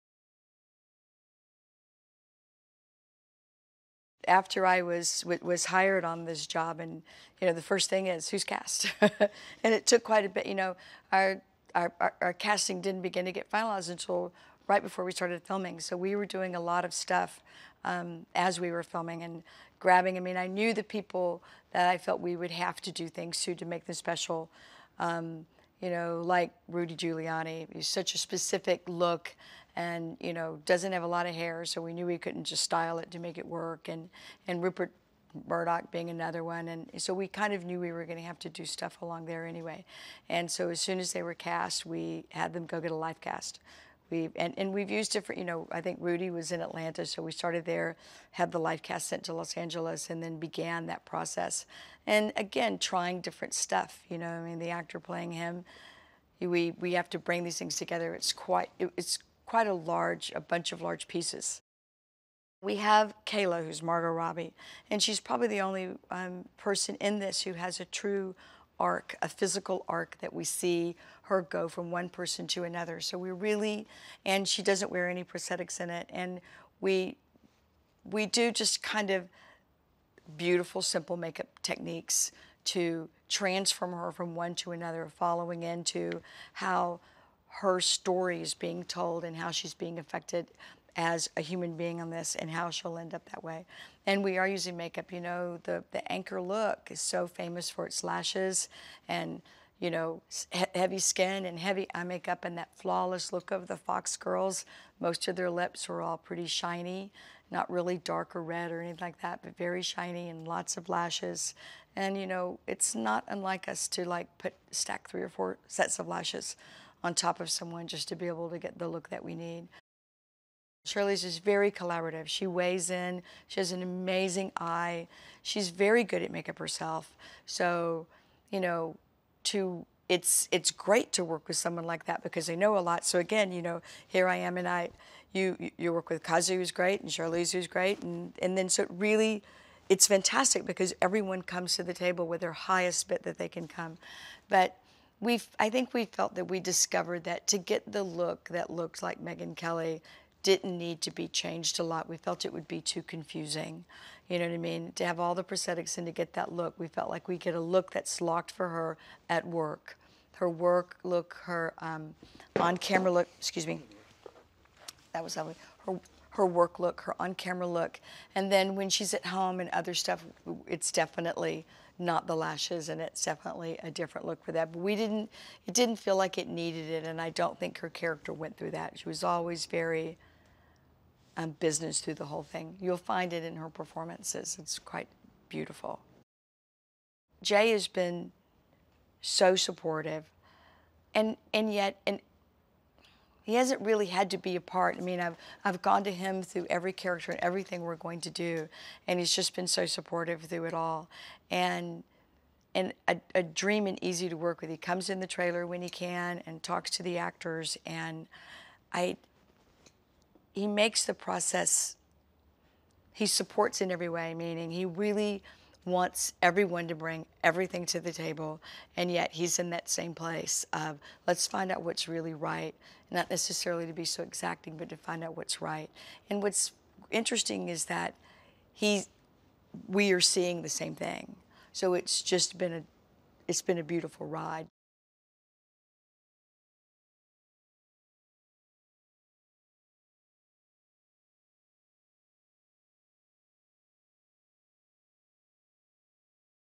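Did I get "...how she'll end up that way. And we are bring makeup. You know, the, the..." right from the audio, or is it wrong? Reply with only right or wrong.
wrong.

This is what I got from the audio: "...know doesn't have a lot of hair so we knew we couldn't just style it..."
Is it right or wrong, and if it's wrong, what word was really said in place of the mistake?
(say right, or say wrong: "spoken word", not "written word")
right.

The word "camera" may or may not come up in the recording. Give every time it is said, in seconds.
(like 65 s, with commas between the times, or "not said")
162 s, 167 s.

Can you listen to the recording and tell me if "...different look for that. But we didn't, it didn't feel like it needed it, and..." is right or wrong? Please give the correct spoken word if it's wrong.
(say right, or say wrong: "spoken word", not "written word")
right.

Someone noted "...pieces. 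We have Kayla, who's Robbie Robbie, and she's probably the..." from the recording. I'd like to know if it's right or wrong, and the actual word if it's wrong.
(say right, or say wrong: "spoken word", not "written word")
wrong: "Margot", not "Robbie".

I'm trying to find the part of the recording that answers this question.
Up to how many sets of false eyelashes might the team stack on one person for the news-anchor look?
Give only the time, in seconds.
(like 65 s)
115 s.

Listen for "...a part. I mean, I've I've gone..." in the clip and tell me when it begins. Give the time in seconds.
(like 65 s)
194 s.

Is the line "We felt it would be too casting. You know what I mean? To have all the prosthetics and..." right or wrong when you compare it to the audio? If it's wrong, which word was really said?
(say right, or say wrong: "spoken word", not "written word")
wrong: "confusing", not "casting".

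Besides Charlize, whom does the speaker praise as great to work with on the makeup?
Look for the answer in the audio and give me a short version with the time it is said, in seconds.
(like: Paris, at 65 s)
Kazu, at 136 s.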